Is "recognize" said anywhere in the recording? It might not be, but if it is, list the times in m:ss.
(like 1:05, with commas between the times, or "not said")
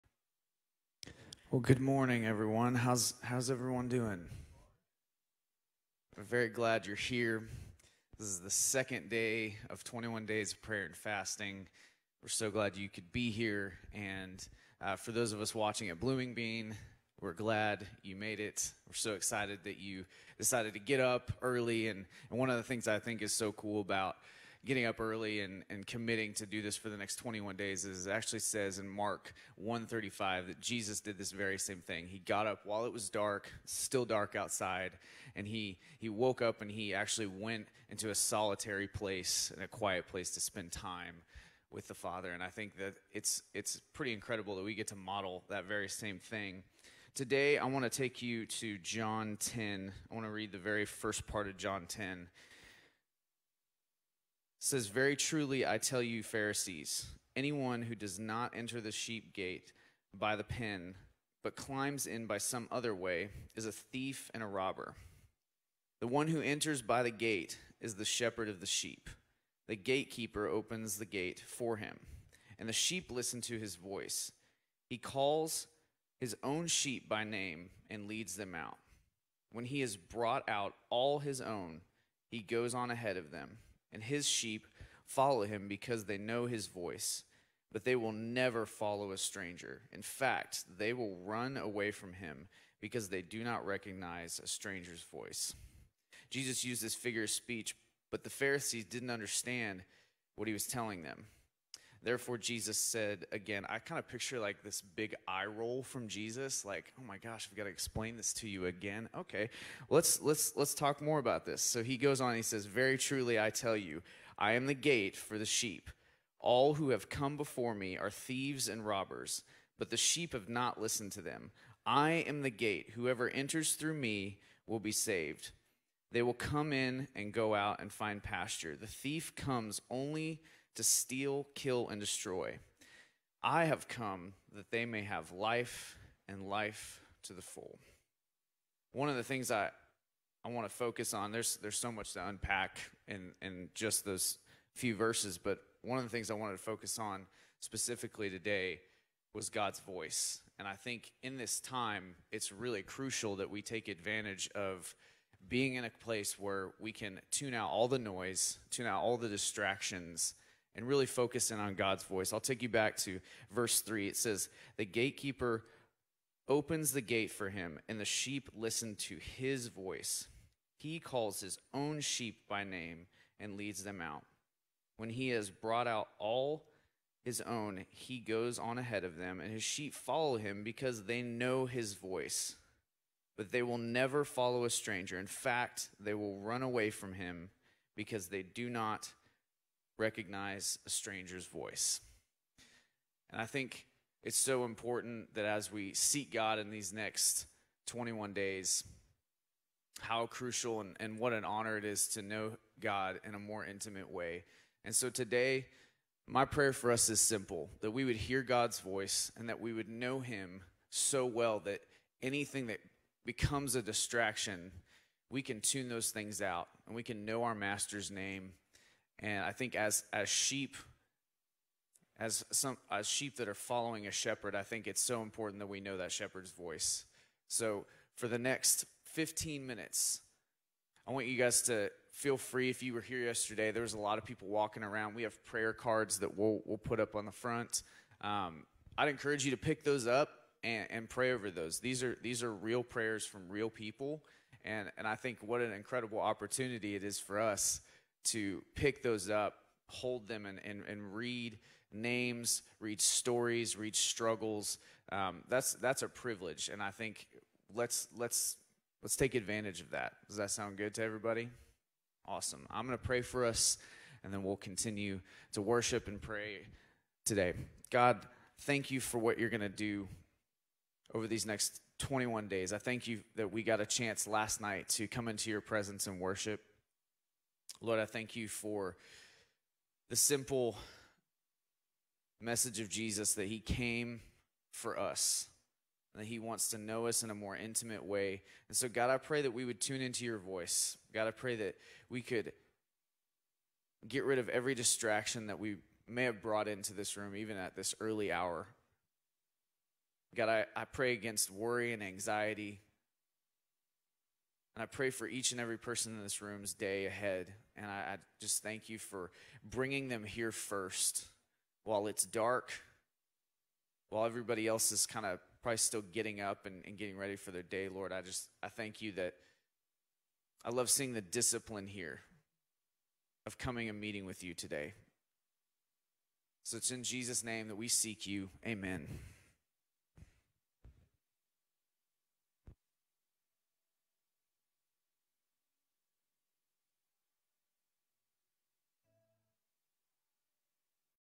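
1:33, 3:10.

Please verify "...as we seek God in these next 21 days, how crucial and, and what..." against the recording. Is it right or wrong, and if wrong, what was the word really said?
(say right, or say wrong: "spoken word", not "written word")
right.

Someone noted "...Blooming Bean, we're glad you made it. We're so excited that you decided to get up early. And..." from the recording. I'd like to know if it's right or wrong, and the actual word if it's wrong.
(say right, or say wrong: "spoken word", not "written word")
right.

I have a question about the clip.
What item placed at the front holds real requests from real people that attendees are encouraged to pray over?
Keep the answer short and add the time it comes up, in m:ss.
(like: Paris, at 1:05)
prayer cards, at 3:55.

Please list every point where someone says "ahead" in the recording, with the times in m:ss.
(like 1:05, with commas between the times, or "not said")
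1:22, 2:58, 5:07.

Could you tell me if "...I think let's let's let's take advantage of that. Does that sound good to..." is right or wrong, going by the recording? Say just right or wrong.
right.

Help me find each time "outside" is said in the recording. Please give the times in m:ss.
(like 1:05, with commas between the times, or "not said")
0:34.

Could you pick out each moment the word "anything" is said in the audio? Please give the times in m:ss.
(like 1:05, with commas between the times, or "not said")
3:32.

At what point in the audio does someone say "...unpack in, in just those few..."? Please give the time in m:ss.
2:22.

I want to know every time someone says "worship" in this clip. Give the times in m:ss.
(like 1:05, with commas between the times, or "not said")
4:25, 4:36.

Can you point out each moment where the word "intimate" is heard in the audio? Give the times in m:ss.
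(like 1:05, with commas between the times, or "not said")
3:23, 4:47.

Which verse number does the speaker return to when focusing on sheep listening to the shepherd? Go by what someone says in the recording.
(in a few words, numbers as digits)
3.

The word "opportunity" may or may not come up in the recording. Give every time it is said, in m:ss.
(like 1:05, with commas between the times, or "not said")
4:06.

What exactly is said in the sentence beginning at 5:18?
I just, I thank you that I love seeing the discipline here of coming and meeting with you today.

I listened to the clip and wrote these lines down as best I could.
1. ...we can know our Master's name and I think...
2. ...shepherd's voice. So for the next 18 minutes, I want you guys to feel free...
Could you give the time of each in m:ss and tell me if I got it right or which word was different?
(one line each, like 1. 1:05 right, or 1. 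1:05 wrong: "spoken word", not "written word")
1. 3:36 right
2. 3:46 wrong: "15", not "18".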